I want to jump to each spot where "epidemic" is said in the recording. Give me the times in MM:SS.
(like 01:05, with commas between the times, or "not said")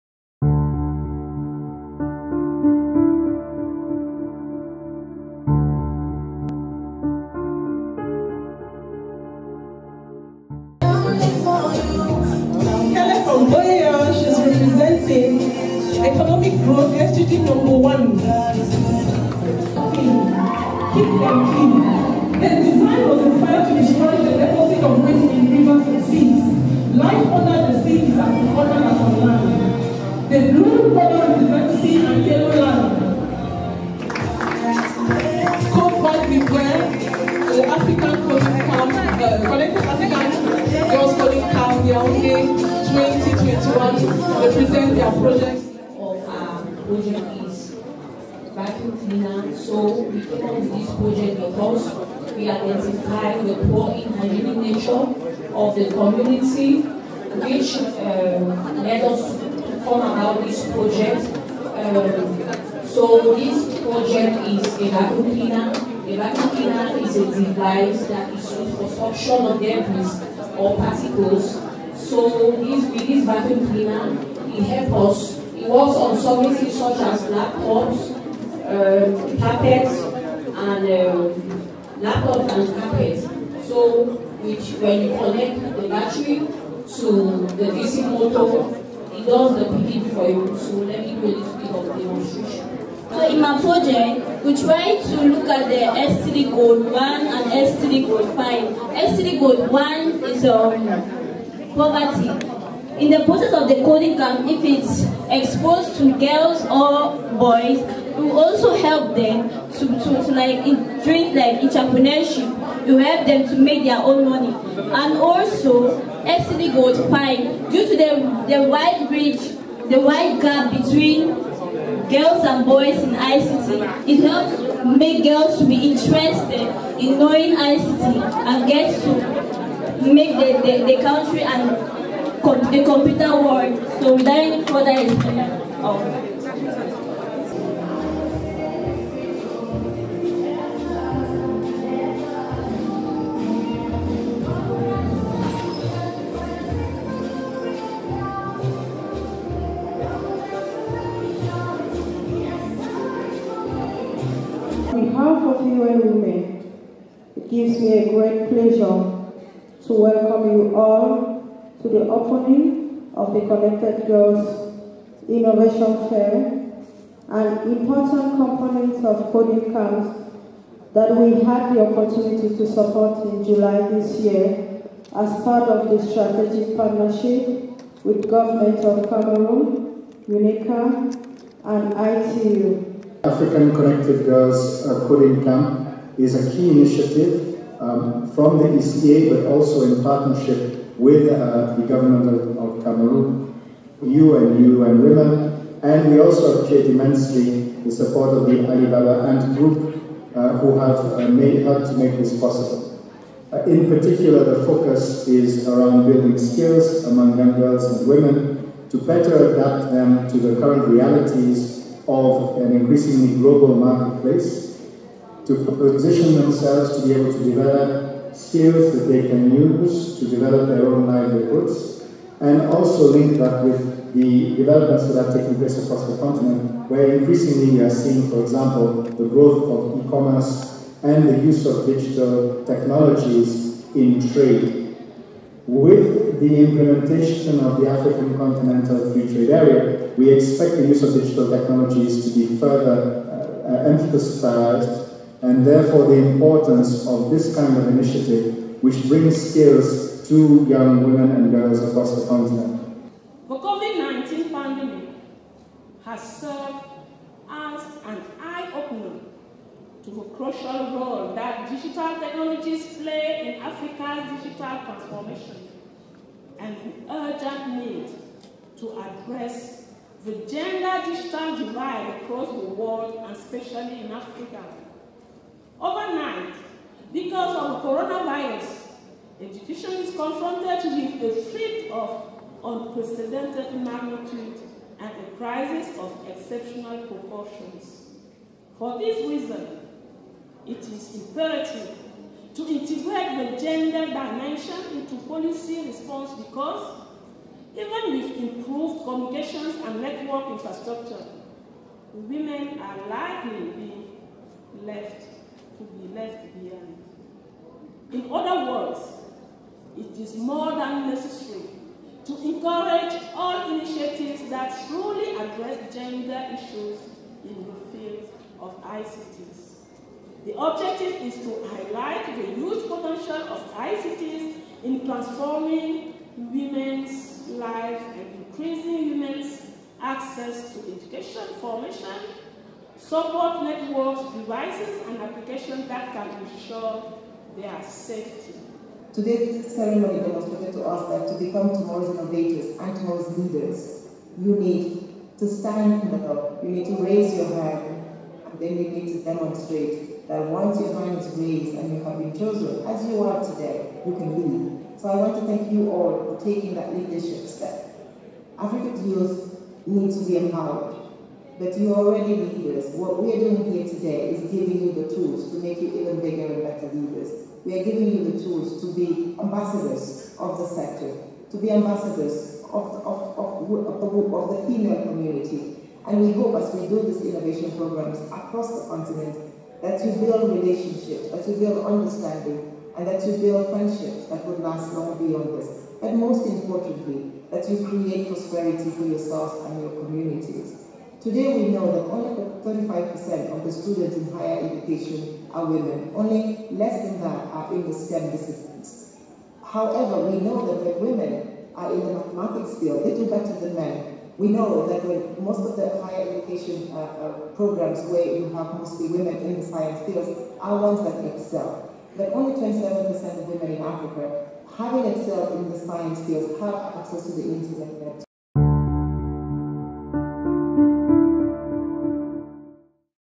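not said.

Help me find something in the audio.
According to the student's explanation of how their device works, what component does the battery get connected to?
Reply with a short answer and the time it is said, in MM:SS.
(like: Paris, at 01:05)
DC motor, at 01:27.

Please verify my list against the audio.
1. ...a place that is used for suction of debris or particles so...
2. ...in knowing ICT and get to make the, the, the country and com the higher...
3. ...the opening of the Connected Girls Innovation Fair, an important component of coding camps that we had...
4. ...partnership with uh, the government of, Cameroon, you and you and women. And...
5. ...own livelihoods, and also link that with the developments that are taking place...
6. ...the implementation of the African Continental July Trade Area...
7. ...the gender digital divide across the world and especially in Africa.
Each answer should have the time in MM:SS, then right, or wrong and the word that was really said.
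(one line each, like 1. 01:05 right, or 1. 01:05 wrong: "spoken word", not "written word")
1. 01:07 wrong: "device", not "place"
2. 02:06 wrong: "computer", not "higher"
3. 02:41 right
4. 03:10 right
5. 03:40 right
6. 03:56 wrong: "Free", not "July"
7. 04:30 right.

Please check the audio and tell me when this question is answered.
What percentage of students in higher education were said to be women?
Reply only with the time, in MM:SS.
06:32.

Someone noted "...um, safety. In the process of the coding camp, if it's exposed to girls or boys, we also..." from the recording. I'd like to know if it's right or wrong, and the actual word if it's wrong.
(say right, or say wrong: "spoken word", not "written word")
wrong: "poverty", not "safety".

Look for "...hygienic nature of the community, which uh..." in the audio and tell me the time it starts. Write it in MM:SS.
00:54.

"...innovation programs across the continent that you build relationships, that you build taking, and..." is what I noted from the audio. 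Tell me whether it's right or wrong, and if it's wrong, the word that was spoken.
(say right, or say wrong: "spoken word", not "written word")
wrong: "understanding", not "taking".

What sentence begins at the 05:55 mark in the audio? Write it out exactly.
So I want to thank you all for taking that leadership step.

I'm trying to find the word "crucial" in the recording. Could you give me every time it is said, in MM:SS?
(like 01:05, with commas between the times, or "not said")
04:20.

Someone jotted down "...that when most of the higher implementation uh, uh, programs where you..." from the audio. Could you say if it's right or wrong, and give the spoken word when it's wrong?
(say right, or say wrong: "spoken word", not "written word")
wrong: "education", not "implementation".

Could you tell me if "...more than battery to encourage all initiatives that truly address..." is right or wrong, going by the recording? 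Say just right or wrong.
wrong.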